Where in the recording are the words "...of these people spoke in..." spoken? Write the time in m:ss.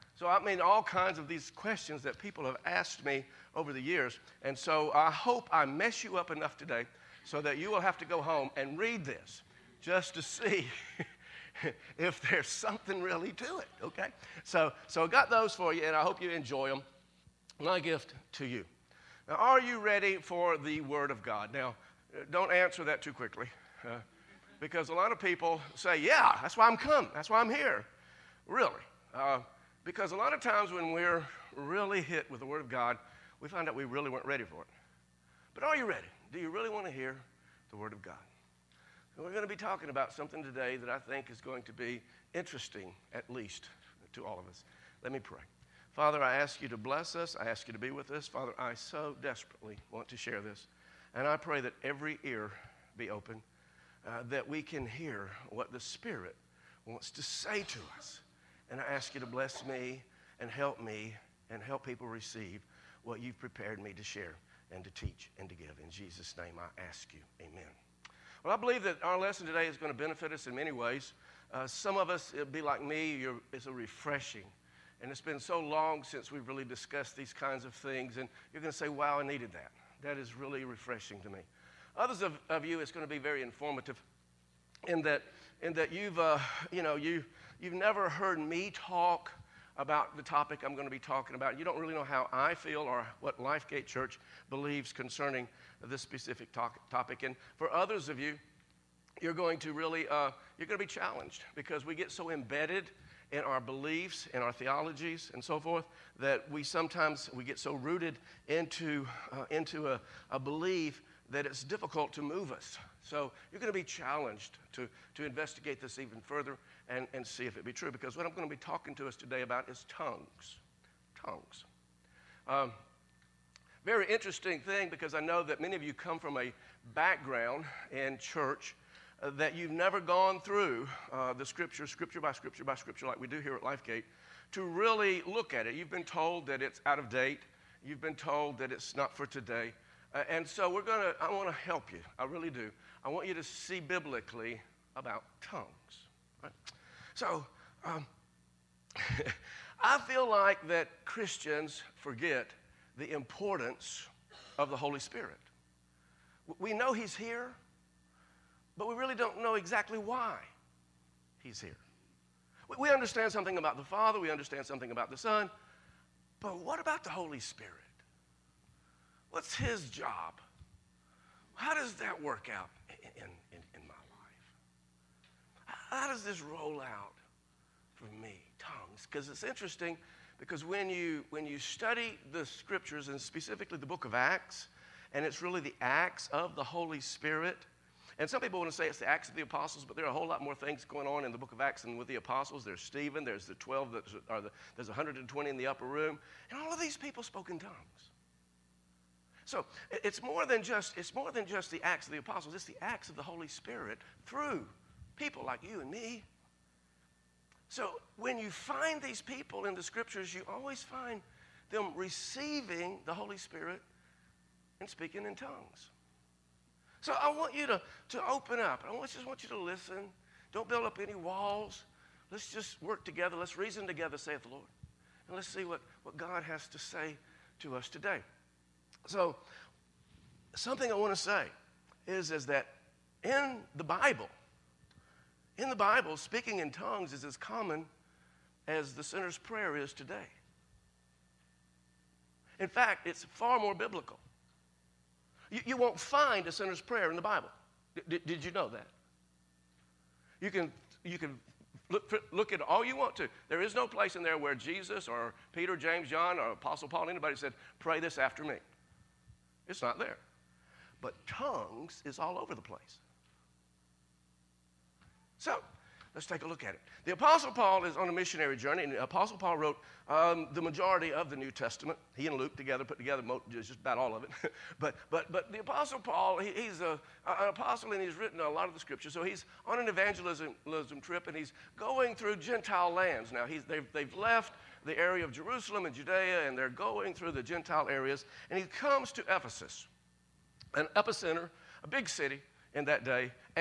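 3:16.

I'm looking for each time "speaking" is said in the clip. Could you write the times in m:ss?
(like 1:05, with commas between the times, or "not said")
3:34, 3:56.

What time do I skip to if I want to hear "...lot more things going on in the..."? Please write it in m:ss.
3:10.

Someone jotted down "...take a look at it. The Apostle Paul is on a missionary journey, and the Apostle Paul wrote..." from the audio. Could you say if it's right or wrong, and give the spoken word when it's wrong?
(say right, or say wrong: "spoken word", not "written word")
right.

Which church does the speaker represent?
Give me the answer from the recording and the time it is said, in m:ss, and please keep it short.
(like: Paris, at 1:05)
Lifegate Church, at 1:33.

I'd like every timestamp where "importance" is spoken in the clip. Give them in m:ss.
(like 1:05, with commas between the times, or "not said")
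2:33.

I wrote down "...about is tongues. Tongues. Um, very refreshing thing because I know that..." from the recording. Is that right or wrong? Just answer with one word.
wrong.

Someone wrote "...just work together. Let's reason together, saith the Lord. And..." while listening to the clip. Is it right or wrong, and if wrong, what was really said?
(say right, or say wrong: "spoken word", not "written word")
right.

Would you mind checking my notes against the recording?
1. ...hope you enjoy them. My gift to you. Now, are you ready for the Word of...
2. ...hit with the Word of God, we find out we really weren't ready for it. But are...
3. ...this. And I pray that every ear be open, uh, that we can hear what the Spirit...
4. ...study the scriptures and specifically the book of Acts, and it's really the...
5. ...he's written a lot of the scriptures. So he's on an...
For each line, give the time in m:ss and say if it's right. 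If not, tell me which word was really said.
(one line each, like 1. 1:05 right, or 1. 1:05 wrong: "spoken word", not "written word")
1. 0:16 right
2. 0:32 right
3. 0:50 right
4. 3:01 right
5. 4:37 right.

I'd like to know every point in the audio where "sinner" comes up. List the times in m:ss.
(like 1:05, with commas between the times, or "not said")
3:59, 4:06.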